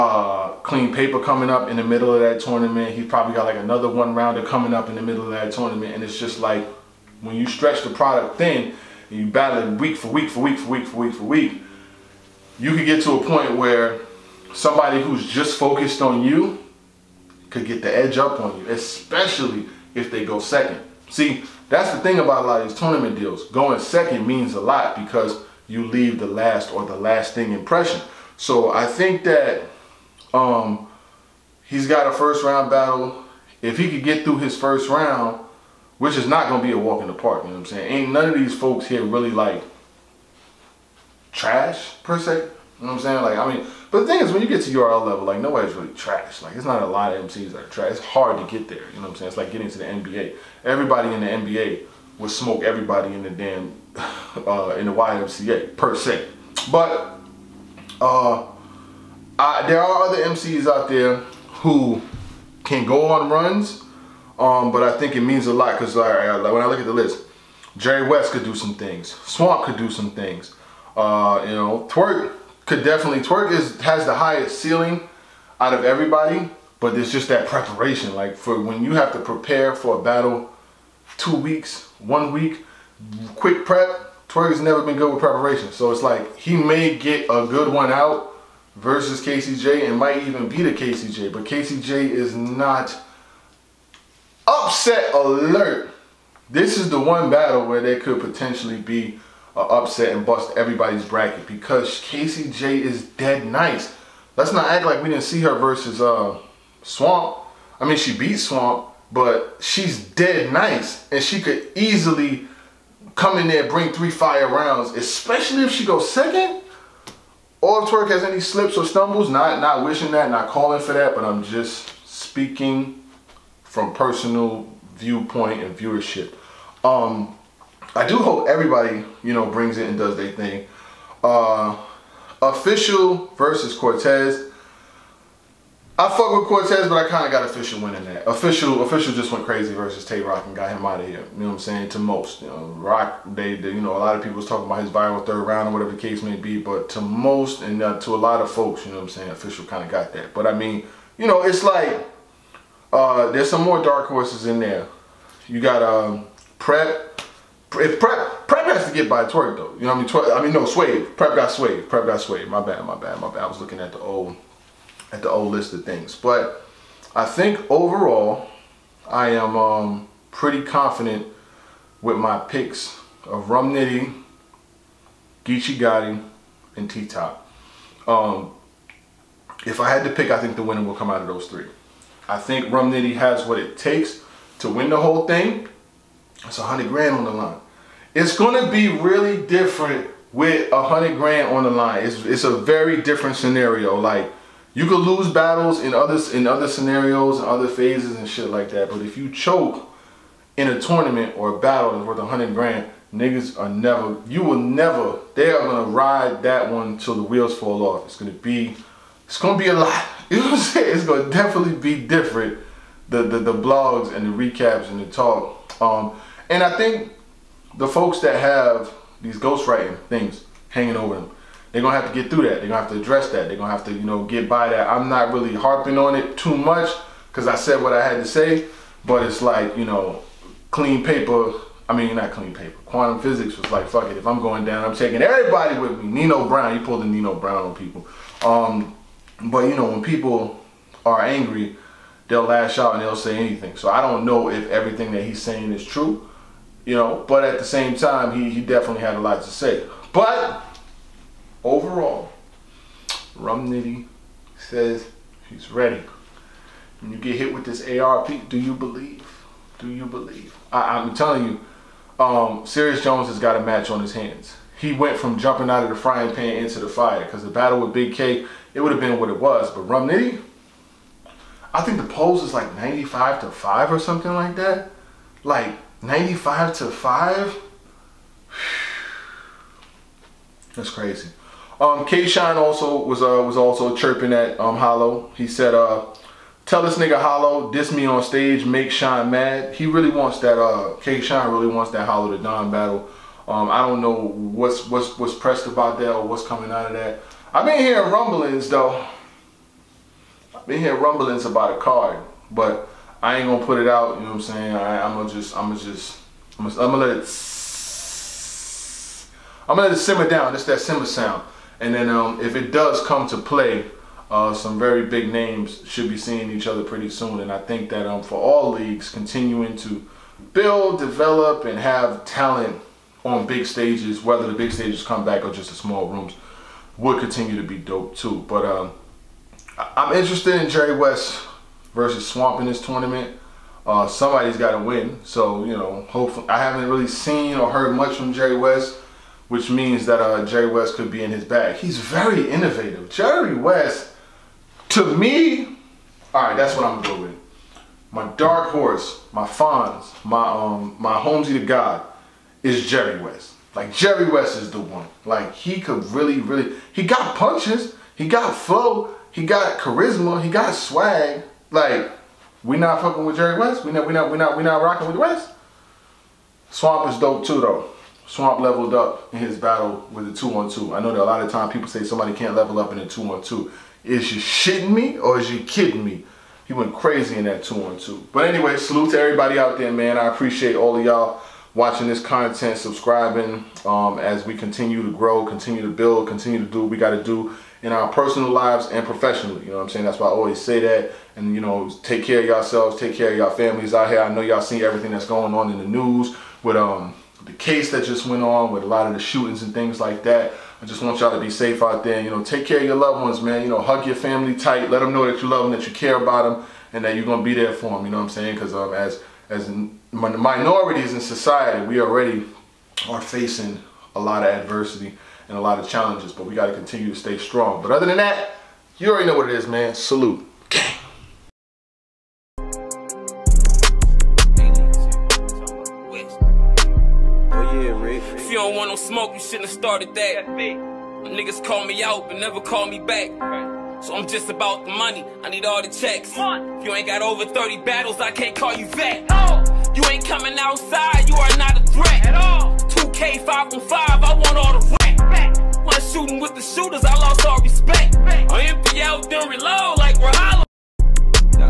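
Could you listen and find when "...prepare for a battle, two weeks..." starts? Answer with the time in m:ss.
1:19.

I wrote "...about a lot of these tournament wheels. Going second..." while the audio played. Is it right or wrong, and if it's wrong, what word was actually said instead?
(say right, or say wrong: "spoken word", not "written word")
wrong: "deals", not "wheels".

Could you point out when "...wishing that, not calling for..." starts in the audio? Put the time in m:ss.
1:59.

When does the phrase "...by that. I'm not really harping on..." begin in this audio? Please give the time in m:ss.
3:44.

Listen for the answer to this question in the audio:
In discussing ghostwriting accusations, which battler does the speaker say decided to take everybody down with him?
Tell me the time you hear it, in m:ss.
3:52.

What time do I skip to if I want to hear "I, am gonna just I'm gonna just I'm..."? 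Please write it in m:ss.
5:04.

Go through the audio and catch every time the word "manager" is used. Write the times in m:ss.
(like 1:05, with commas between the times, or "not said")
not said.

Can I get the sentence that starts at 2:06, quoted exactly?
Um, I do hope everybody, you know, brings it and does their thing.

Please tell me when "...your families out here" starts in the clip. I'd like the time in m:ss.
6:33.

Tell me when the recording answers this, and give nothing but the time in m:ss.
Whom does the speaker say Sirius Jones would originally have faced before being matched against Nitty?
4:27.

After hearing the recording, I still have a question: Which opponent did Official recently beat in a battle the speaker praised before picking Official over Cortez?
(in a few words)
Tay Roc.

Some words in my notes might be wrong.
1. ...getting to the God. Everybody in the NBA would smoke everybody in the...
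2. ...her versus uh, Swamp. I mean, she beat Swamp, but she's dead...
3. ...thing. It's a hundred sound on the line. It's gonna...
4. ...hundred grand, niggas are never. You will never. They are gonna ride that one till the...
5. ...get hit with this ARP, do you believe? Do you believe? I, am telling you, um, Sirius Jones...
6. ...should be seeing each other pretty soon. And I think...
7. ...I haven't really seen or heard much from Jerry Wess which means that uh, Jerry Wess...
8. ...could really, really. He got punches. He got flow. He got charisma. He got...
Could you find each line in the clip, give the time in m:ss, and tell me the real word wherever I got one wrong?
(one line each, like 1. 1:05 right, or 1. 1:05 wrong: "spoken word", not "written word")
1. 0:49 wrong: "NBA", not "God"
2. 1:45 right
3. 3:05 wrong: "grand", not "sound"
4. 3:22 right
5. 4:17 right
6. 5:15 right
7. 5:36 right
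8. 5:55 right.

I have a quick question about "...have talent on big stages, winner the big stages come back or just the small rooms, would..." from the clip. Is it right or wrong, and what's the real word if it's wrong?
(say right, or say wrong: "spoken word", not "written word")
wrong: "whether", not "winner".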